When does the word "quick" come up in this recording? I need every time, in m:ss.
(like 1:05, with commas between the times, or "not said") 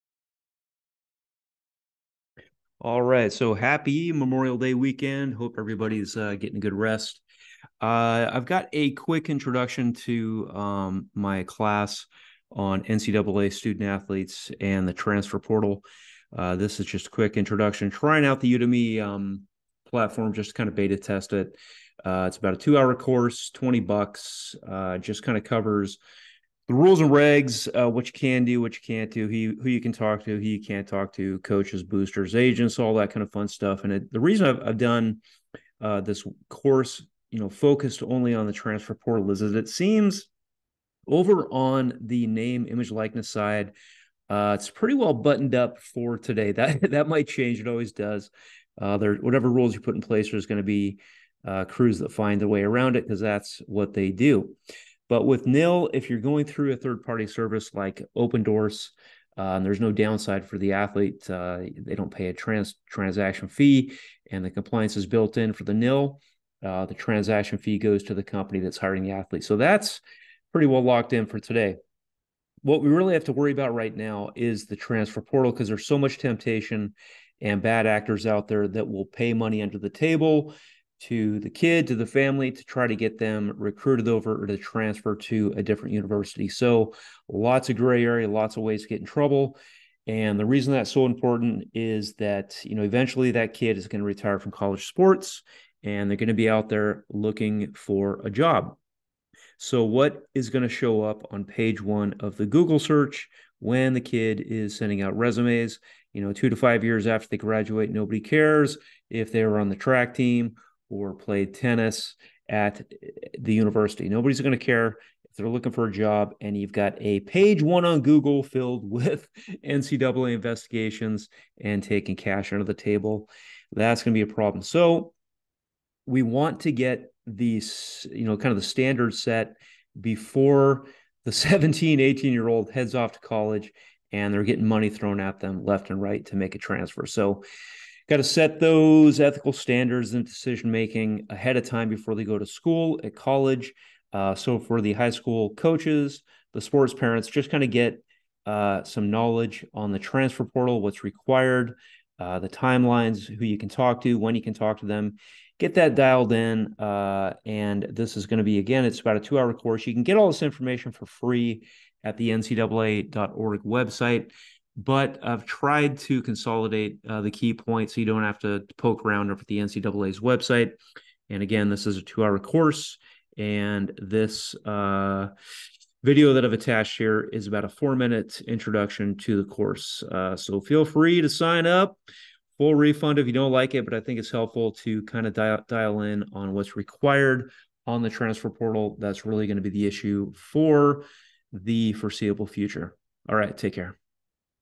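0:08, 0:17.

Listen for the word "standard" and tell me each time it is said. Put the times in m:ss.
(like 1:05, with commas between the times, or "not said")
2:08, 2:19.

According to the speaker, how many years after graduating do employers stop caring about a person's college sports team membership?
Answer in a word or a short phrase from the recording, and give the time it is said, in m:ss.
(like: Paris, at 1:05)
2 to 5, at 1:46.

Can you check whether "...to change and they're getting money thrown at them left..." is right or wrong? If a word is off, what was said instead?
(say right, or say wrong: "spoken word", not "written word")
wrong: "college", not "change".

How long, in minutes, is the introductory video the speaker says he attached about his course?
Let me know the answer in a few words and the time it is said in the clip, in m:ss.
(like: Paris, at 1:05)
4, at 2:57.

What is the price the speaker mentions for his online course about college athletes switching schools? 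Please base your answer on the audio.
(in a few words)
$20.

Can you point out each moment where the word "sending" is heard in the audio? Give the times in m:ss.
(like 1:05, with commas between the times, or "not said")
1:44.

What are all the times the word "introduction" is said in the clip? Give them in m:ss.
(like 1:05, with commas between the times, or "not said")
0:09, 0:17, 2:58.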